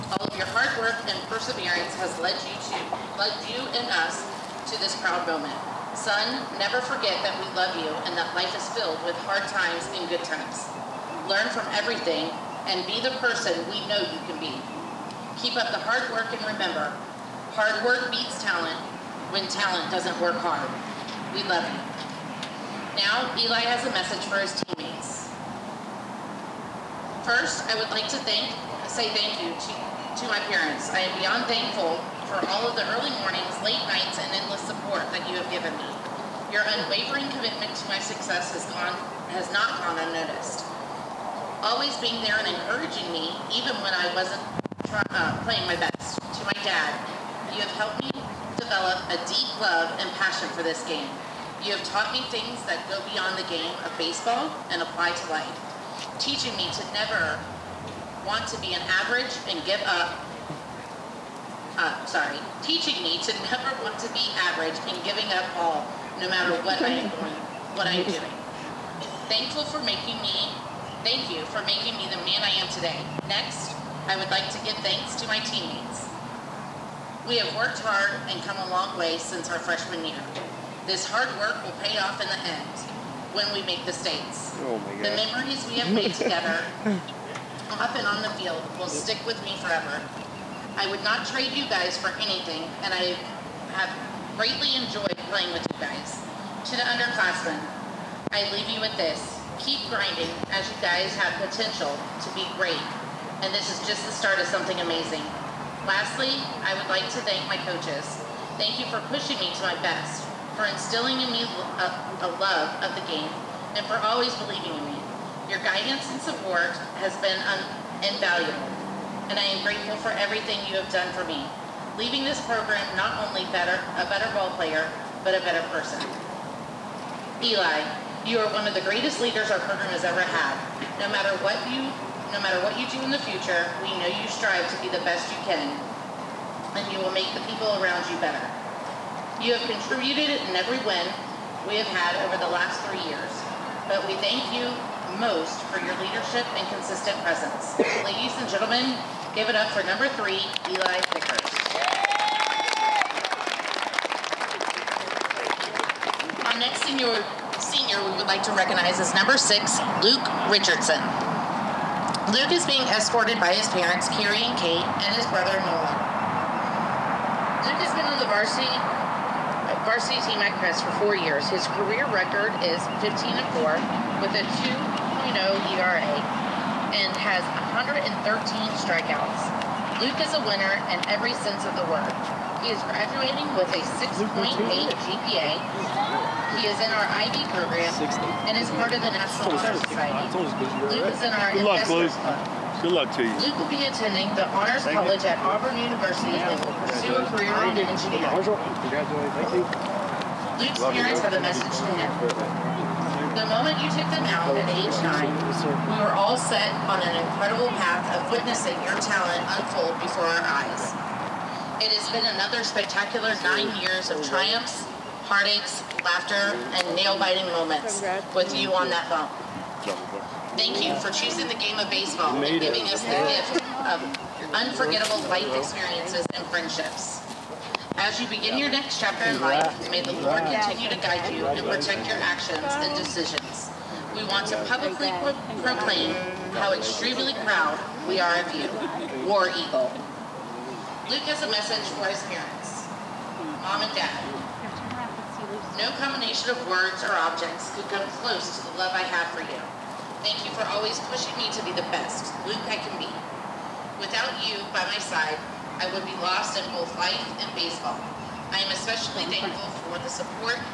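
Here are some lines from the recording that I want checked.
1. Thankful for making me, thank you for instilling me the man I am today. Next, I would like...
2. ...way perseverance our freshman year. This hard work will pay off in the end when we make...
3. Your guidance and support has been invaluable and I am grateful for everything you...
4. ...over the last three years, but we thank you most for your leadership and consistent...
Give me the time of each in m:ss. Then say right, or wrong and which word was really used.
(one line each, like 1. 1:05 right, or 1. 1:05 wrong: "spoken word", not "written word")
1. 1:09 wrong: "making", not "instilling"
2. 1:18 wrong: "since", not "perseverance"
3. 1:55 right
4. 2:22 right.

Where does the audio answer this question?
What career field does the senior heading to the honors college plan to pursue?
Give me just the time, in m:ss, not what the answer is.
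3:17.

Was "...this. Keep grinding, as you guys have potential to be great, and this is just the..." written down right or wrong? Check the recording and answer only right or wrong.
right.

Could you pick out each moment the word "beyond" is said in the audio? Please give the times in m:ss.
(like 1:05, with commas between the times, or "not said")
0:31, 0:53.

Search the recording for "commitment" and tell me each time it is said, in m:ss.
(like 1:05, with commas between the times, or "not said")
0:37.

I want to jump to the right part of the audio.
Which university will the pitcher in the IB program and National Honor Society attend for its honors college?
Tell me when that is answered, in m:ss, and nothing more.
3:15.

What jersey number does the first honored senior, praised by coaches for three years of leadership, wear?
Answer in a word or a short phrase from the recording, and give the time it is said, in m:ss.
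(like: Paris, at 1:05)
3, at 2:29.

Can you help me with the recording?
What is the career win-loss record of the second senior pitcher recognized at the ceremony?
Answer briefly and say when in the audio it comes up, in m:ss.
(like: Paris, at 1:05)
15 and 4, at 2:53.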